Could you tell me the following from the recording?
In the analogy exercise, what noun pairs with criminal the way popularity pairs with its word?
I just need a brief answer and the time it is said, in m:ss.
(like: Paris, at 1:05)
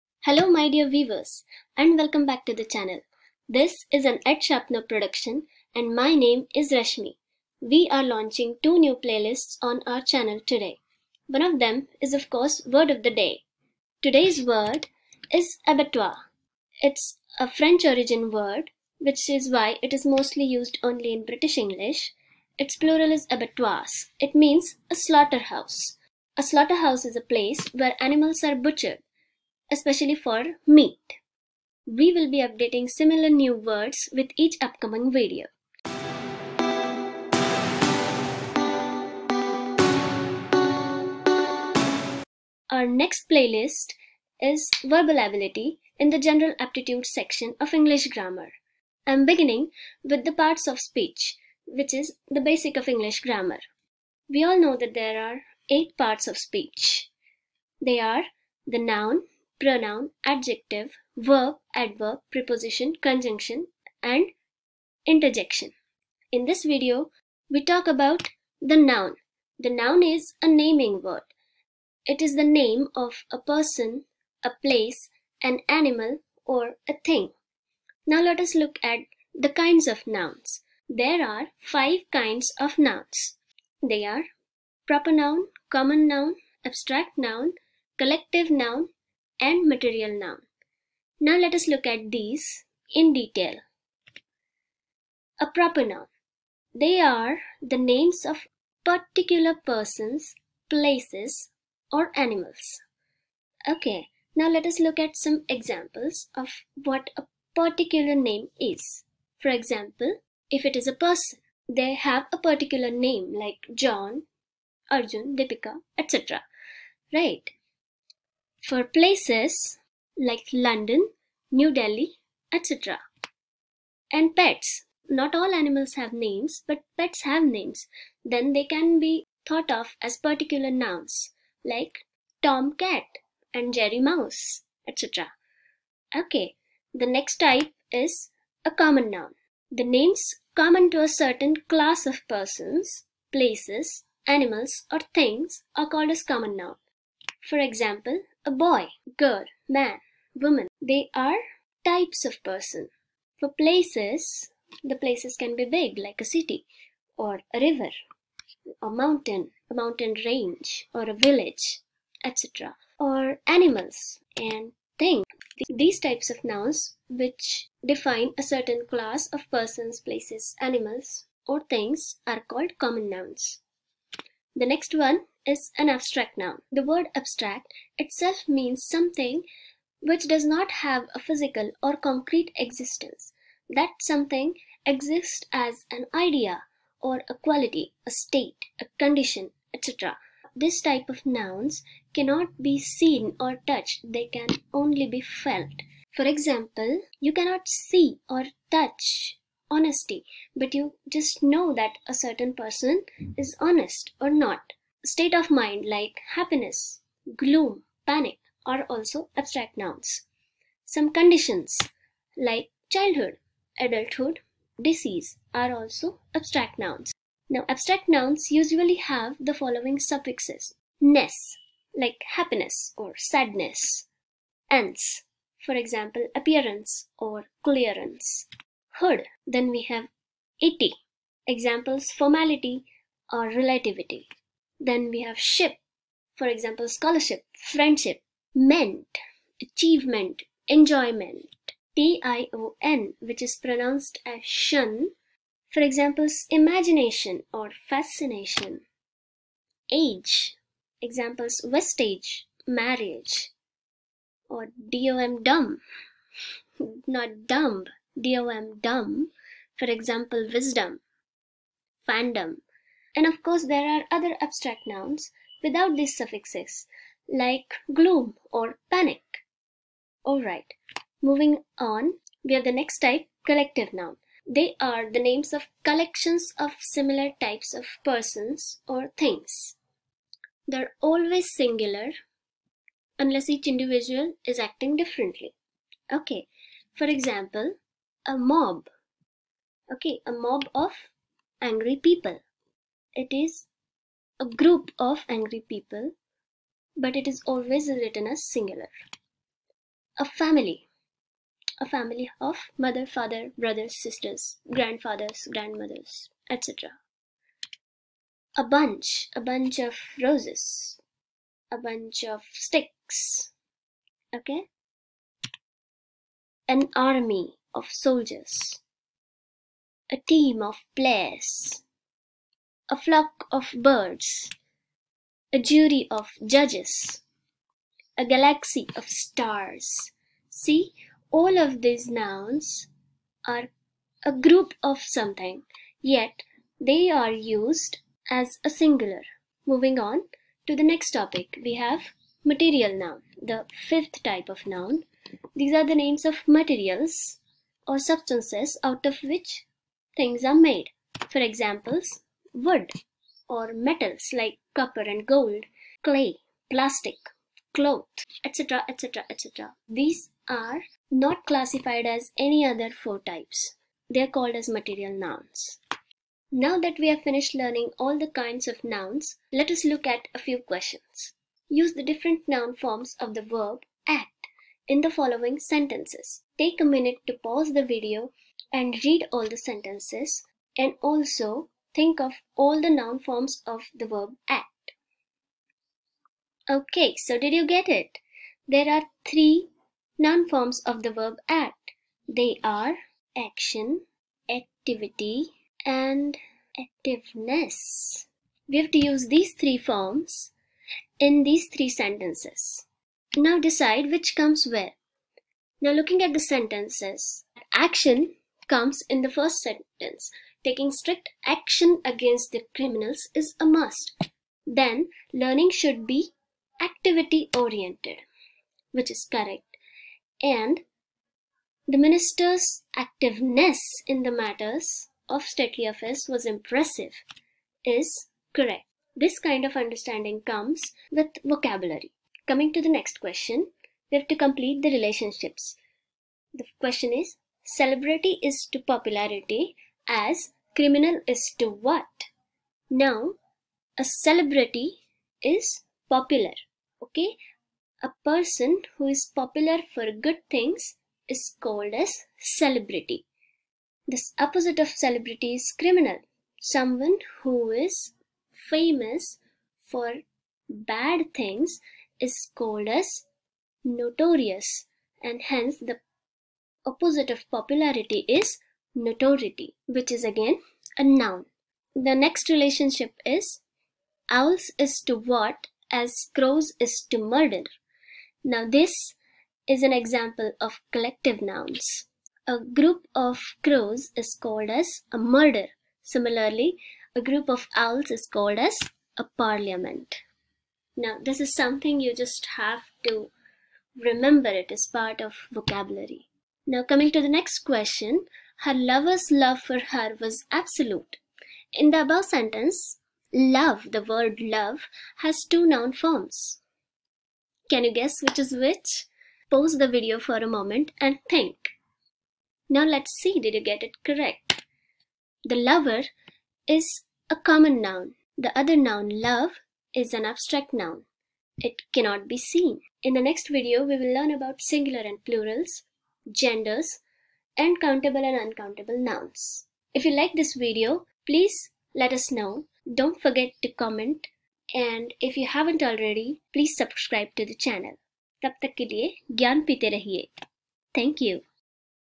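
Notoriety, at 7:48.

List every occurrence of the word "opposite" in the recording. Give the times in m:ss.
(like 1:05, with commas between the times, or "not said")
7:34, 7:46.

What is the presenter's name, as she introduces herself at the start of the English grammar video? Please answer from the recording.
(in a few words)
Rashmi.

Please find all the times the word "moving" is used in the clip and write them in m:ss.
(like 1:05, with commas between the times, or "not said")
4:31, 5:39.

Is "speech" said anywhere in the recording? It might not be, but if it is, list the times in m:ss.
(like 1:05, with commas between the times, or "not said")
0:50, 0:56.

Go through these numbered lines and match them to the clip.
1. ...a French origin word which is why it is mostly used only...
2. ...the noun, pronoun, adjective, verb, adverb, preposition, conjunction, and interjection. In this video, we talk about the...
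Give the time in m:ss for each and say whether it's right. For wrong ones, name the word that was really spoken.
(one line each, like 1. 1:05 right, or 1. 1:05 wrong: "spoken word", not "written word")
1. 0:17 right
2. 0:58 right.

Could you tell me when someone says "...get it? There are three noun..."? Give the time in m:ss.
6:27.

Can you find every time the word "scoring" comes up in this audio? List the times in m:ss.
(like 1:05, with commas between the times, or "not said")
not said.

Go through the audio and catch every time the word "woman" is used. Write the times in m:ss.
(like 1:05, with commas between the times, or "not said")
2:30.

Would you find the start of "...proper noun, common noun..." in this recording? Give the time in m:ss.
1:24.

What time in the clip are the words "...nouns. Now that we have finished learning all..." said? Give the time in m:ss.
6:05.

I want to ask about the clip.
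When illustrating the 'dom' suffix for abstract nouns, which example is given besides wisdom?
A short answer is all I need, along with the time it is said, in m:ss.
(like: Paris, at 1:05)
Fandom, at 4:22.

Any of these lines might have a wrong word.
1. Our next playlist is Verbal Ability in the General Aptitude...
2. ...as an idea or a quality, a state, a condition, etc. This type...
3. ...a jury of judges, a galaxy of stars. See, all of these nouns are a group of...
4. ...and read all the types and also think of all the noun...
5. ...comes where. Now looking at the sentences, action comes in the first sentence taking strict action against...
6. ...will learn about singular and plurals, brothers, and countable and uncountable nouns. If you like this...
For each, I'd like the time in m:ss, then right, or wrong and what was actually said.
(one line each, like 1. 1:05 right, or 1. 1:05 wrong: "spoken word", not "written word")
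1. 0:42 right
2. 3:05 right
3. 5:25 right
4. 6:18 wrong: "sentences", not "types"
5. 6:44 right
6. 8:43 wrong: "genders", not "brothers".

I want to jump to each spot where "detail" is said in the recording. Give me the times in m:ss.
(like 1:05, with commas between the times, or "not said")
1:33.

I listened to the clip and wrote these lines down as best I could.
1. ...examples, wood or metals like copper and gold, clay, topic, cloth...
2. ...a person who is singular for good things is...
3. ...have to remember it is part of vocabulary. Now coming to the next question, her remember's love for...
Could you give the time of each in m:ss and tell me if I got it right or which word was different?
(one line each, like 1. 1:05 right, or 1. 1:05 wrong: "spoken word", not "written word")
1. 5:51 wrong: "plastic", not "topic"
2. 7:28 wrong: "popular", not "singular"
3. 8:12 wrong: "lover", not "remember".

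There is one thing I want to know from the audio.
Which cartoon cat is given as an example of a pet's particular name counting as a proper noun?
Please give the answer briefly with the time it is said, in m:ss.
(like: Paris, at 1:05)
Tom, at 2:12.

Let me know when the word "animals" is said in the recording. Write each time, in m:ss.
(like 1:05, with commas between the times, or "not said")
0:28, 1:15, 1:42, 2:05, 2:24, 2:43, 2:50.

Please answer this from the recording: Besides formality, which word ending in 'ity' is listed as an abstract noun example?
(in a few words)
Relativity.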